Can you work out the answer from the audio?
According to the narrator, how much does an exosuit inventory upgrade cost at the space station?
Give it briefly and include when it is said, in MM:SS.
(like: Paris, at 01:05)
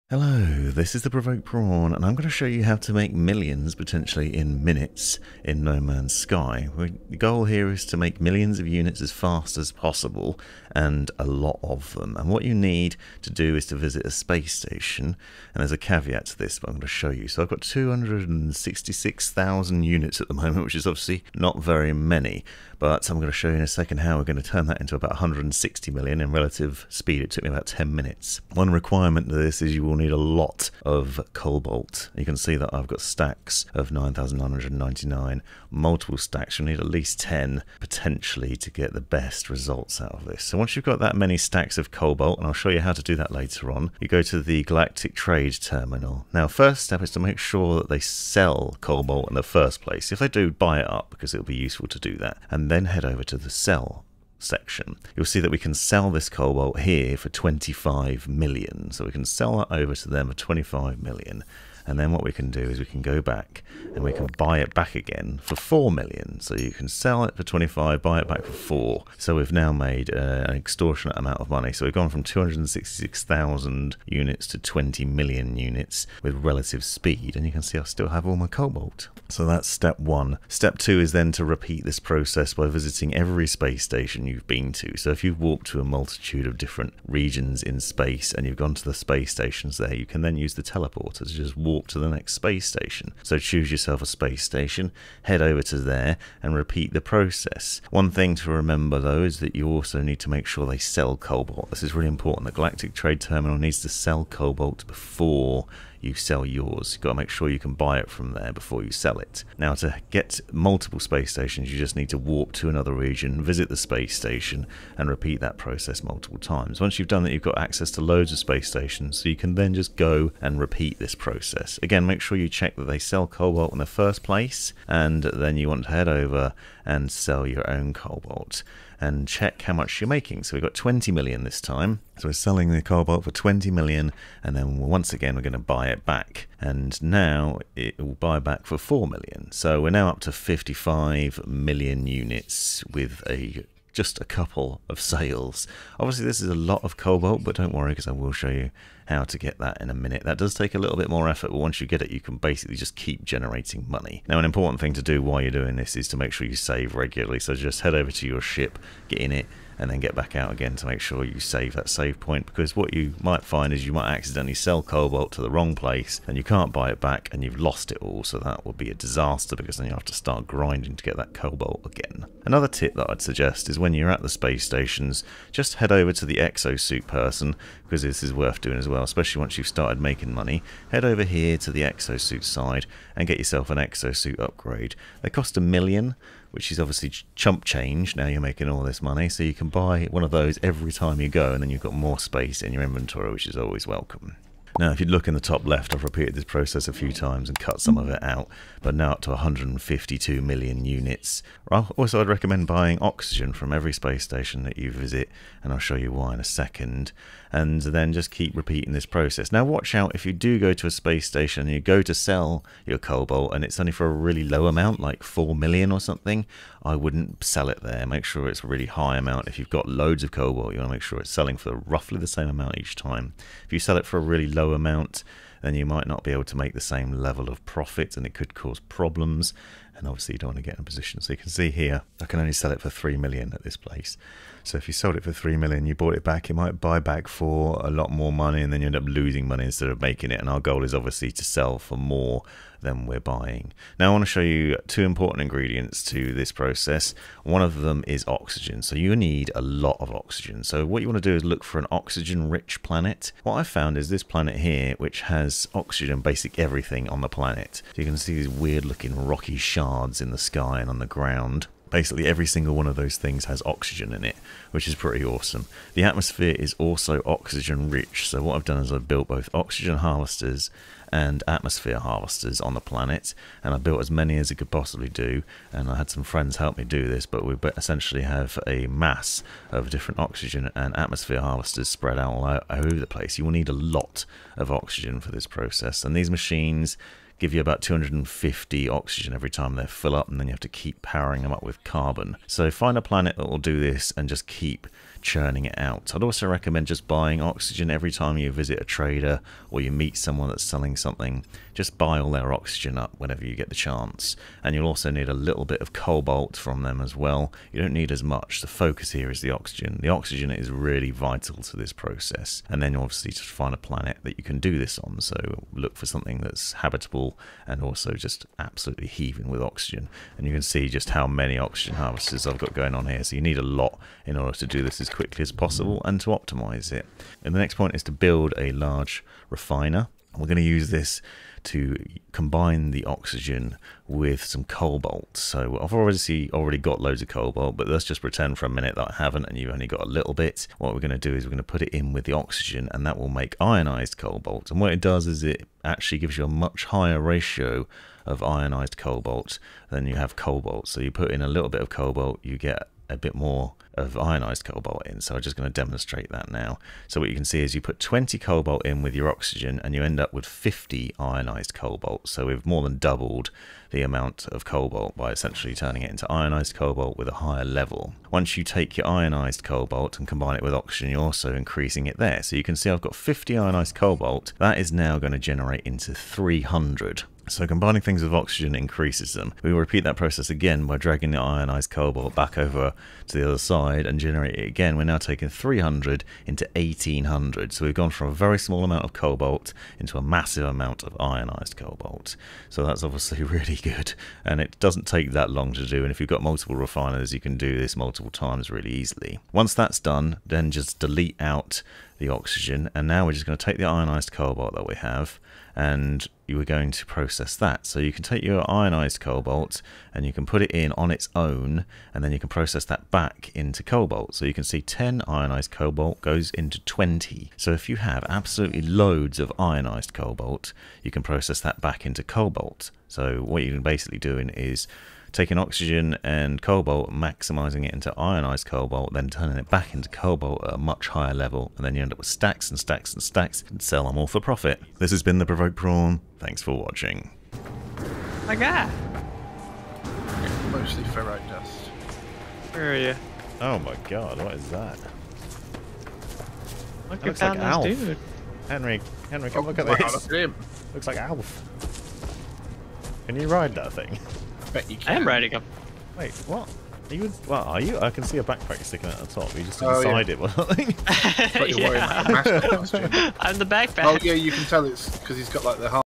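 a million, at 03:05.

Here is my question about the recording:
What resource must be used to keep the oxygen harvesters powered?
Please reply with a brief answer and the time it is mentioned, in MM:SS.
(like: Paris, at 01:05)
carbon, at 04:51.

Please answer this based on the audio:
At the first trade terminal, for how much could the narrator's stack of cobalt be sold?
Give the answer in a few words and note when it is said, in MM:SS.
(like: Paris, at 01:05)
25 million, at 00:55.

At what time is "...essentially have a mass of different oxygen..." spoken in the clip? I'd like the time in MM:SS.
04:37.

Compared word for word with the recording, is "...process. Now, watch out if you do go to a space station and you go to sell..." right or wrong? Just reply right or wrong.
right.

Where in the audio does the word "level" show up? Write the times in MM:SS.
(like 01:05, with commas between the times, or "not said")
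03:47, 06:07, 07:11.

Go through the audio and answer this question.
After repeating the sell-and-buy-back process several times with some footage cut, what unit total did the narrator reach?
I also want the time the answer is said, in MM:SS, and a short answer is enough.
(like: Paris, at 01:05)
152 million, at 03:19.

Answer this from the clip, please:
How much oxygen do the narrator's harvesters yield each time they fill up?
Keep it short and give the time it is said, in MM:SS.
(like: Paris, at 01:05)
about 250, at 04:47.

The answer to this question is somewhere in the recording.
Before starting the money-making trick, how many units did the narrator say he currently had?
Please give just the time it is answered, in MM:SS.
00:17.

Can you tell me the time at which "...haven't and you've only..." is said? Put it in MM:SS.
05:39.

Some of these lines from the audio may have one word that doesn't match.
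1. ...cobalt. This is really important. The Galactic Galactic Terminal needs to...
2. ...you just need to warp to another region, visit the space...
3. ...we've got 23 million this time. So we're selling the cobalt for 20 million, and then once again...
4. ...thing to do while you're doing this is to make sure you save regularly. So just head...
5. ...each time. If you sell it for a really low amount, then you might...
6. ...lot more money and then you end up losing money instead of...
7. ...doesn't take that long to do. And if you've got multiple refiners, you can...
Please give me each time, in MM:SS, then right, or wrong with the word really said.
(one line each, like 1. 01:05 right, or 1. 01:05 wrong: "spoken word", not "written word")
1. 01:41 wrong: "Trade", not "Galactic"
2. 01:51 right
3. 02:10 wrong: "20", not "23"
4. 02:34 right
5. 03:42 right
6. 03:57 right
7. 06:34 right.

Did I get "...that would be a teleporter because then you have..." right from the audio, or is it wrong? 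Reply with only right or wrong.
wrong.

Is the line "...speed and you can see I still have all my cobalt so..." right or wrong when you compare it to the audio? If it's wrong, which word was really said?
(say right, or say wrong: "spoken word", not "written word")
right.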